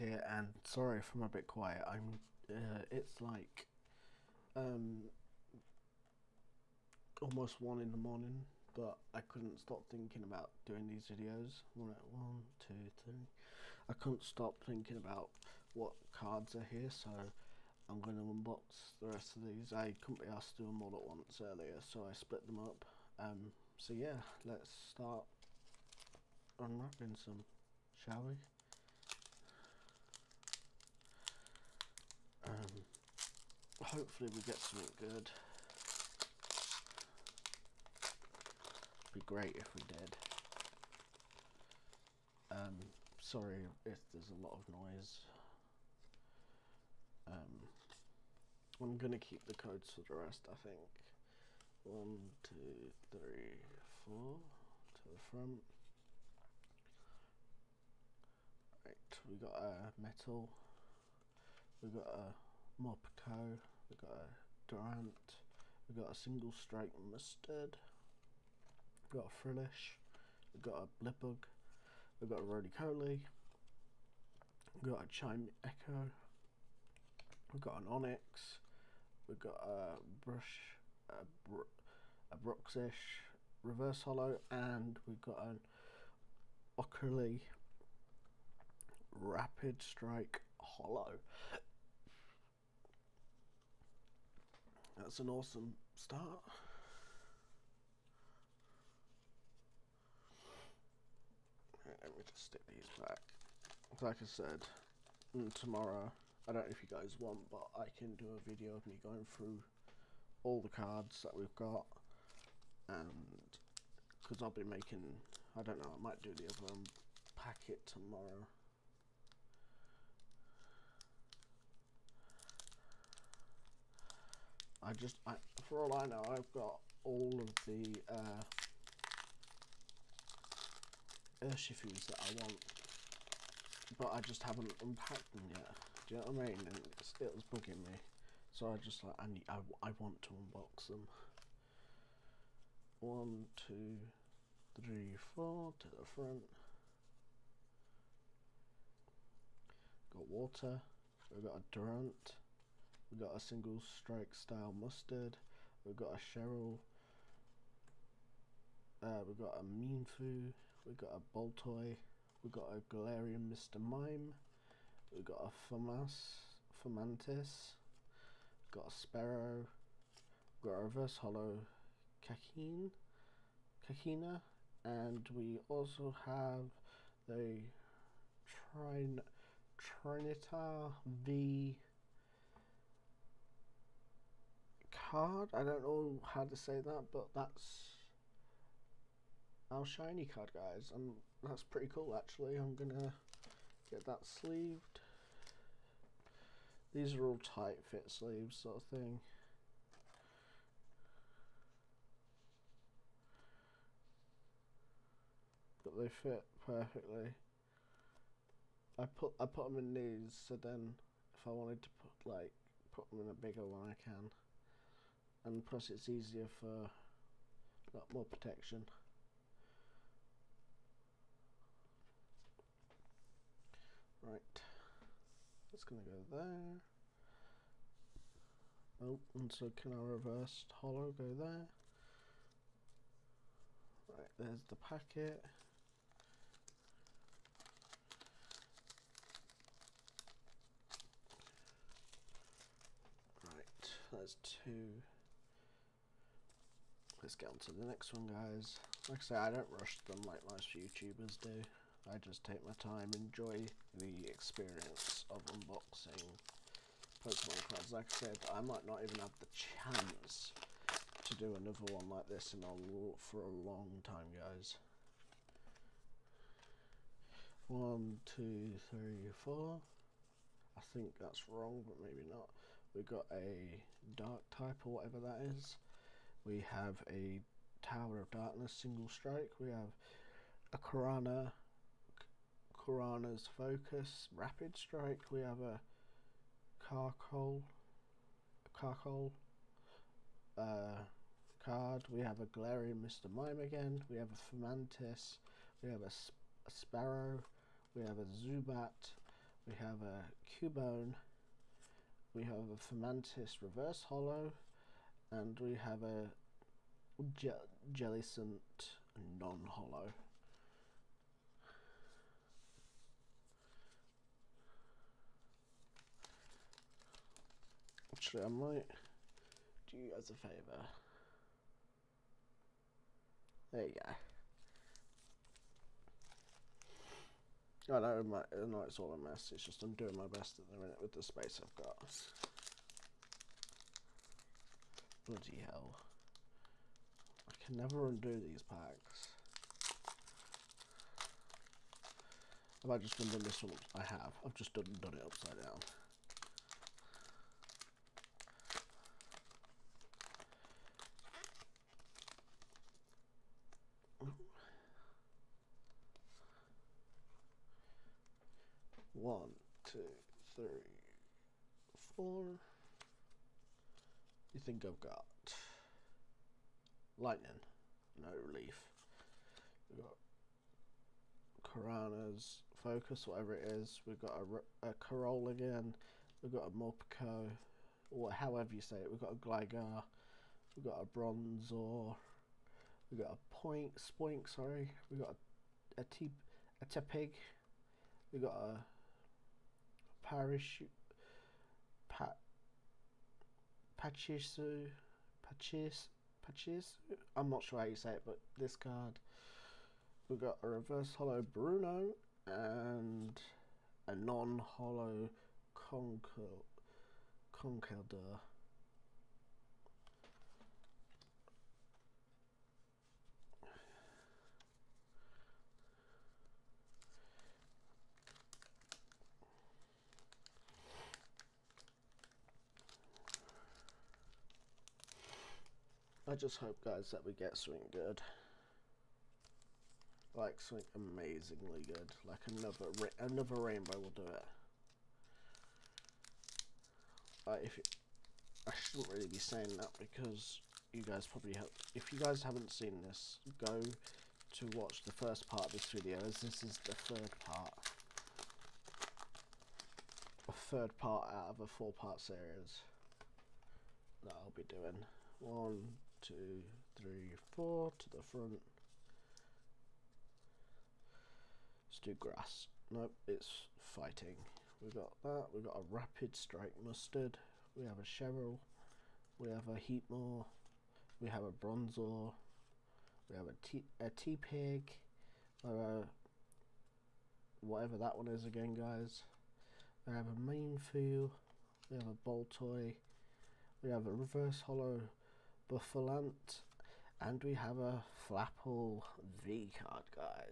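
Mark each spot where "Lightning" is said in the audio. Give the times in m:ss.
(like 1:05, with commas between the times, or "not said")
6:07.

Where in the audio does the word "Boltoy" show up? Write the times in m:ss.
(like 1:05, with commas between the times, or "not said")
2:41, 8:02.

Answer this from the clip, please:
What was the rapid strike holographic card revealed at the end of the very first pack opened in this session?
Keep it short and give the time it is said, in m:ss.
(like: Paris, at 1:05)
Ockerly, at 1:26.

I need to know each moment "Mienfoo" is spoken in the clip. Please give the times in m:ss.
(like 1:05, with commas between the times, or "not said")
8:00.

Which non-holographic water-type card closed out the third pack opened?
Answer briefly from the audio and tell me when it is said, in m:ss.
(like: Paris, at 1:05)
Jellicent, at 5:07.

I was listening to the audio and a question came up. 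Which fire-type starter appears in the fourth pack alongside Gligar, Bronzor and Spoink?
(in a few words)
Tepig.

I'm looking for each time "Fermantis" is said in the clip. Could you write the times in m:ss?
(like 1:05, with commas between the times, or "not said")
4:54, 5:02.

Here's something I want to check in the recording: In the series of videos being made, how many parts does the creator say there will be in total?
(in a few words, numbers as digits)
4.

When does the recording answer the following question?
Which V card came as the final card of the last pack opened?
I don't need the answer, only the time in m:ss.
8:08.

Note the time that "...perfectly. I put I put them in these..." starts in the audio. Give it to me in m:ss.
3:26.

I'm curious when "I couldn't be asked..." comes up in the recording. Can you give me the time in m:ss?
0:19.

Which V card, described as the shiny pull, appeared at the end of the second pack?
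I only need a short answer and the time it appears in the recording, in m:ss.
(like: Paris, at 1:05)
Trinitar V, at 2:58.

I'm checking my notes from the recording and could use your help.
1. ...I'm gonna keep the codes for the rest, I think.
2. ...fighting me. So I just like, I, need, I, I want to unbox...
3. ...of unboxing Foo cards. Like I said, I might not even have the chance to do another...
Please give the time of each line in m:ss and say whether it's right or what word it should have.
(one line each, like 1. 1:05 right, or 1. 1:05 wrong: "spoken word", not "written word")
1. 0:48 right
2. 2:17 wrong: "bugging", not "fighting"
3. 4:15 wrong: "Pokemon", not "Foo".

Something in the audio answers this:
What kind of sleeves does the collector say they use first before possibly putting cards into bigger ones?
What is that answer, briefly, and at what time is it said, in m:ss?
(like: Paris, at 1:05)
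tight fit sleeves, at 3:17.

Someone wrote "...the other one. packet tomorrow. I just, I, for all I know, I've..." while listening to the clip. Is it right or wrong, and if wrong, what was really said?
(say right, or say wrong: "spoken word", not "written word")
right.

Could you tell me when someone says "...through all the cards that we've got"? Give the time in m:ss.
1:49.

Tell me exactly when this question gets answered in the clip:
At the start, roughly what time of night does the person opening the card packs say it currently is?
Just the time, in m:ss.
0:07.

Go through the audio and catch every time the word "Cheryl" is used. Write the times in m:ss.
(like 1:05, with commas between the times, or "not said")
2:36, 7:48.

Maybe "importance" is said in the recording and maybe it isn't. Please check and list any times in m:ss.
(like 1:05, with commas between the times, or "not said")
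not said.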